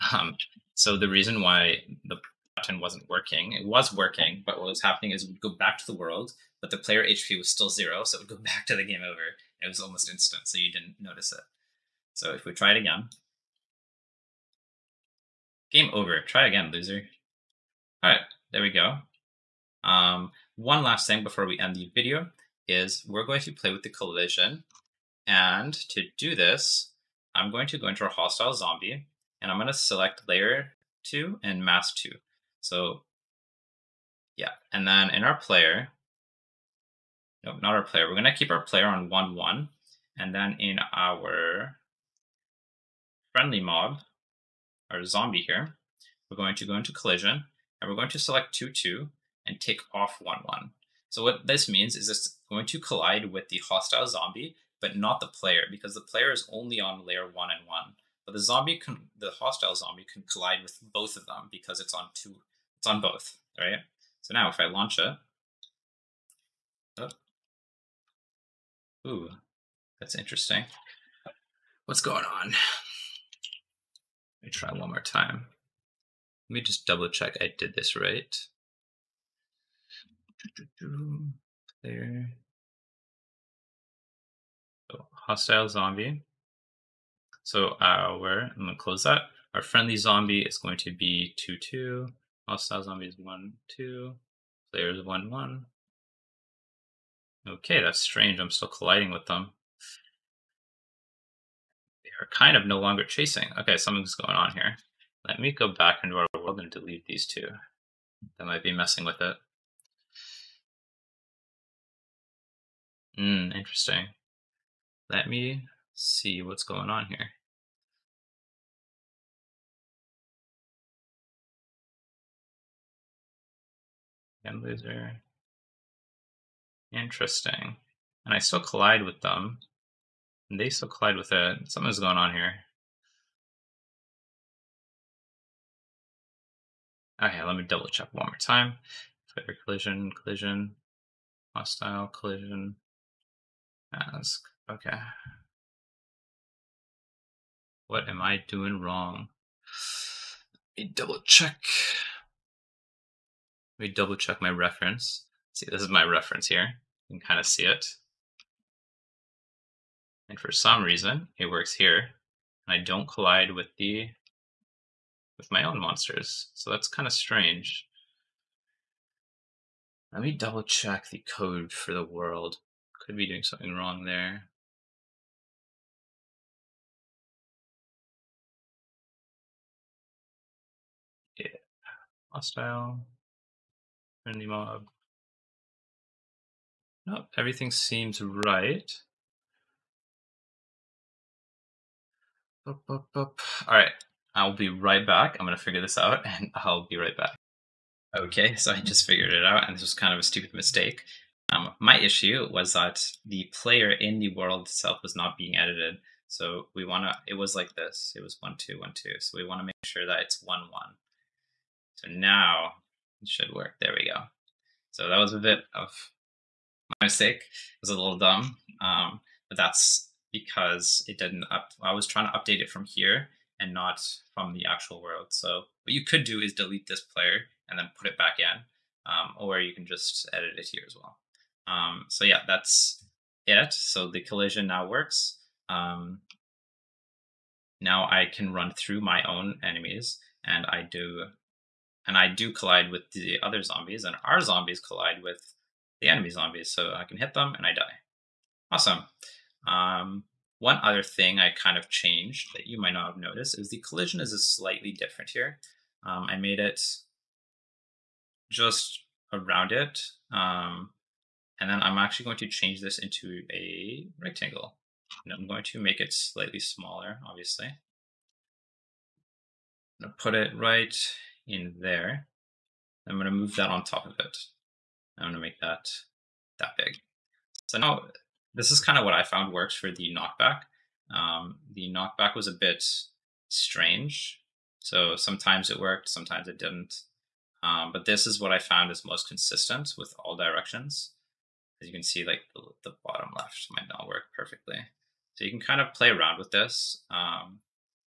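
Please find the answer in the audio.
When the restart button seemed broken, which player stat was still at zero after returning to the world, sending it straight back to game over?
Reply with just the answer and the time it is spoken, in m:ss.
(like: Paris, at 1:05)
HP, at 0:06.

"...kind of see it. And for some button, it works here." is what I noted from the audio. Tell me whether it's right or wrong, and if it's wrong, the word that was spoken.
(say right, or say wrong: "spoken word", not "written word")
wrong: "reason", not "button".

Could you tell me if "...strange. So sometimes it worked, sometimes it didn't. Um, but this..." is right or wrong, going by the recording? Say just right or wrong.
right.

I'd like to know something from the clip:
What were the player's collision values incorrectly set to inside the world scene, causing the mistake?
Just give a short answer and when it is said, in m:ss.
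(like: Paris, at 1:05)
1, 2, 1, 2, at 3:28.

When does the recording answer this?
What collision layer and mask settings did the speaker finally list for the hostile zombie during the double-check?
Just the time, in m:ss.
1:32.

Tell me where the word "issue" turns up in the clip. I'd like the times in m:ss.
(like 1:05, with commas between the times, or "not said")
3:21.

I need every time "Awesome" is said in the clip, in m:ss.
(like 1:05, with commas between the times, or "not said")
4:08.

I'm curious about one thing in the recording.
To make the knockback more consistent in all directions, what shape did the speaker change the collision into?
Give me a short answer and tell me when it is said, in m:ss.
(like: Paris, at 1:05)
Rectangle, at 4:24.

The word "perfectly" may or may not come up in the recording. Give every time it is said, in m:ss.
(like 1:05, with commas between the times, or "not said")
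4:54.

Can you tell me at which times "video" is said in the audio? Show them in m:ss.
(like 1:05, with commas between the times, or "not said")
0:21.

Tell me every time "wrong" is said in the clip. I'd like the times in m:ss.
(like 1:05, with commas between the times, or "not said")
2:28, 2:53.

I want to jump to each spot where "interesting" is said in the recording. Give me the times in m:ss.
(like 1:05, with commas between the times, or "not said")
1:10, 1:53, 2:06.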